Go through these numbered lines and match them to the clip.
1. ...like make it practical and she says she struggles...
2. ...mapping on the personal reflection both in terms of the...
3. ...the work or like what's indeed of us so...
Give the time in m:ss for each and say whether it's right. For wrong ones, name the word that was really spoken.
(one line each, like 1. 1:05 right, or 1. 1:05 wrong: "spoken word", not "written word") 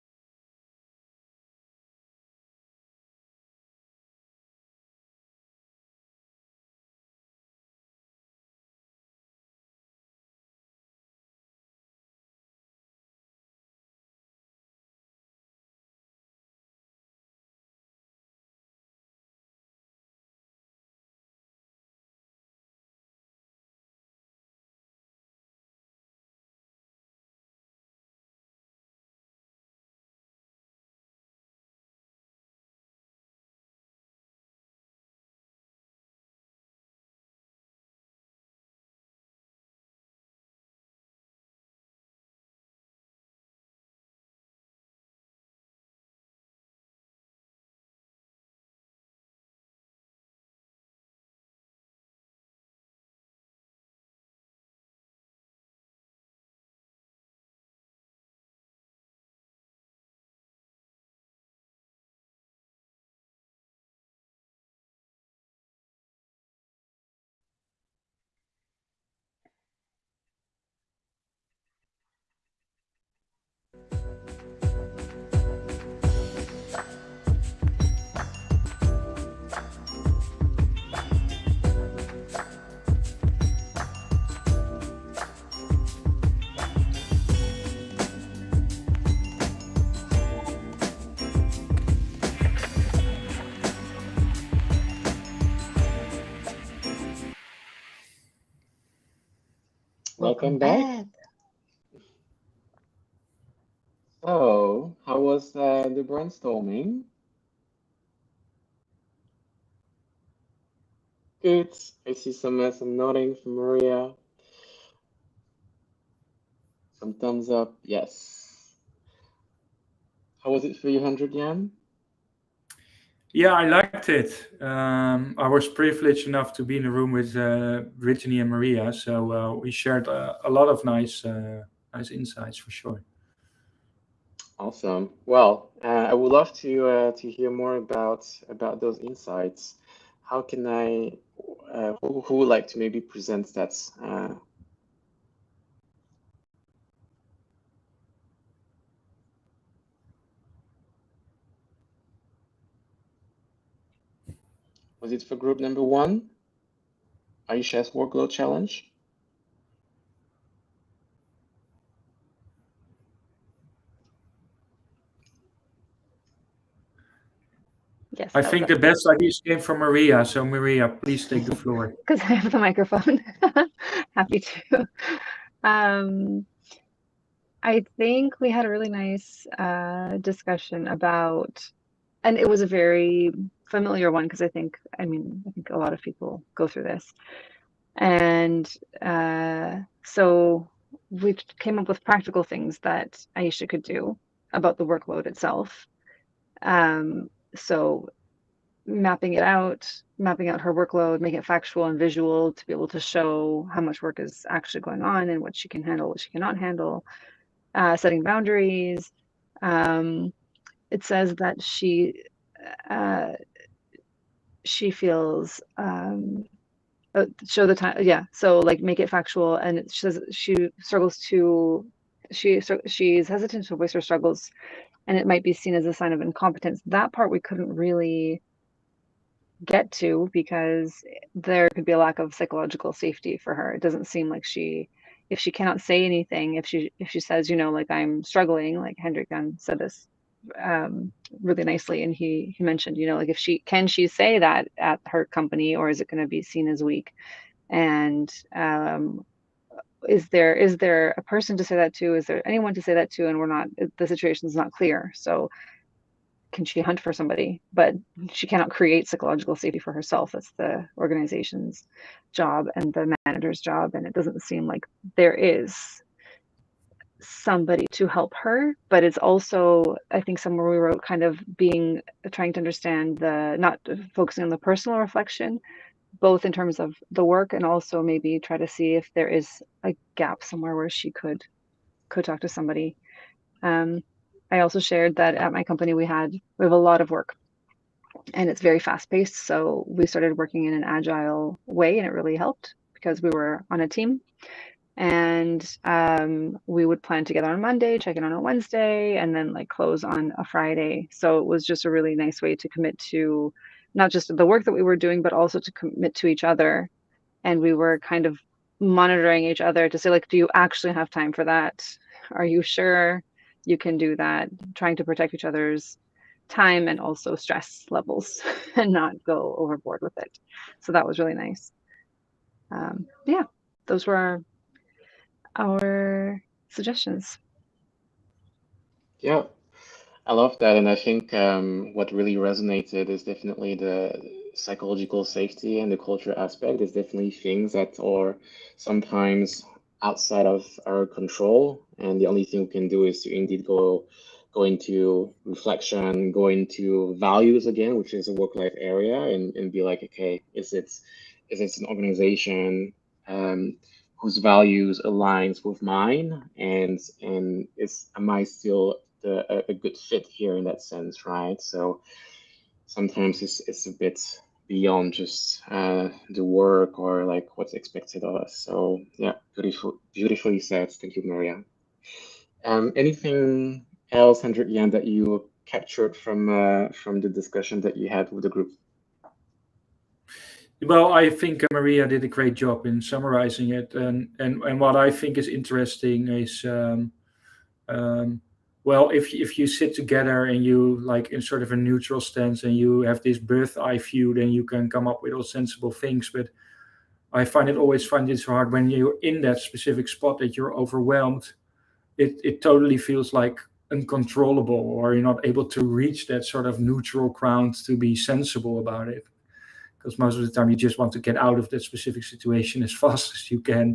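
1. 3:38 wrong: "factual", not "practical"
2. 4:34 wrong: "focusing", not "mapping"
3. 6:06 wrong: "expected", not "indeed".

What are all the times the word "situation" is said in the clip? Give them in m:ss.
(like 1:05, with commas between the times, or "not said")
4:14, 6:52.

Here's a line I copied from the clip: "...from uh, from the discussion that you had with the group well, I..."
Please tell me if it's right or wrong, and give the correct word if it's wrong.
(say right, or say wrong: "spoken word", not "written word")
right.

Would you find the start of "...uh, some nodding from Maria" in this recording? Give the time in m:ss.
1:52.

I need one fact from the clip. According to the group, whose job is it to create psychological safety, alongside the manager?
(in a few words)
The organization.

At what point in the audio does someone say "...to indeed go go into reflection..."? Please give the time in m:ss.
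5:43.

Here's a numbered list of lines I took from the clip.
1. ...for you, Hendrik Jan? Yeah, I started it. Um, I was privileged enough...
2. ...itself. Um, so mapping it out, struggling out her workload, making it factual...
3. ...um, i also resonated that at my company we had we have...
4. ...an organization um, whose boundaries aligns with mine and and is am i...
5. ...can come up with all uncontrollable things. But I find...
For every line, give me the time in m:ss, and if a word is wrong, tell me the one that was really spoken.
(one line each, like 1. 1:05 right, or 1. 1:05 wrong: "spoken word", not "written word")
1. 2:00 wrong: "liked", not "started"
2. 3:15 wrong: "mapping", not "struggling"
3. 4:43 wrong: "shared", not "resonated"
4. 5:51 wrong: "values", not "boundaries"
5. 6:34 wrong: "sensible", not "uncontrollable".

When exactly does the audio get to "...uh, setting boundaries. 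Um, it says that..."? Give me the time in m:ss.
3:27.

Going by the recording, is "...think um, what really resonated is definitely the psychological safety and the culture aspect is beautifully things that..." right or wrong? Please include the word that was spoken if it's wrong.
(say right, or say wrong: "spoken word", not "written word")
wrong: "definitely", not "beautifully".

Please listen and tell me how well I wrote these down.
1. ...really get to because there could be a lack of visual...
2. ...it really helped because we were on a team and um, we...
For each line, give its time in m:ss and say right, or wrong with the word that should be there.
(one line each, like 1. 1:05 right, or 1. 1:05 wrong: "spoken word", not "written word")
1. 3:47 wrong: "psychological", not "visual"
2. 4:52 right.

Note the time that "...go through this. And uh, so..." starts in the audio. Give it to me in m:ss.
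3:06.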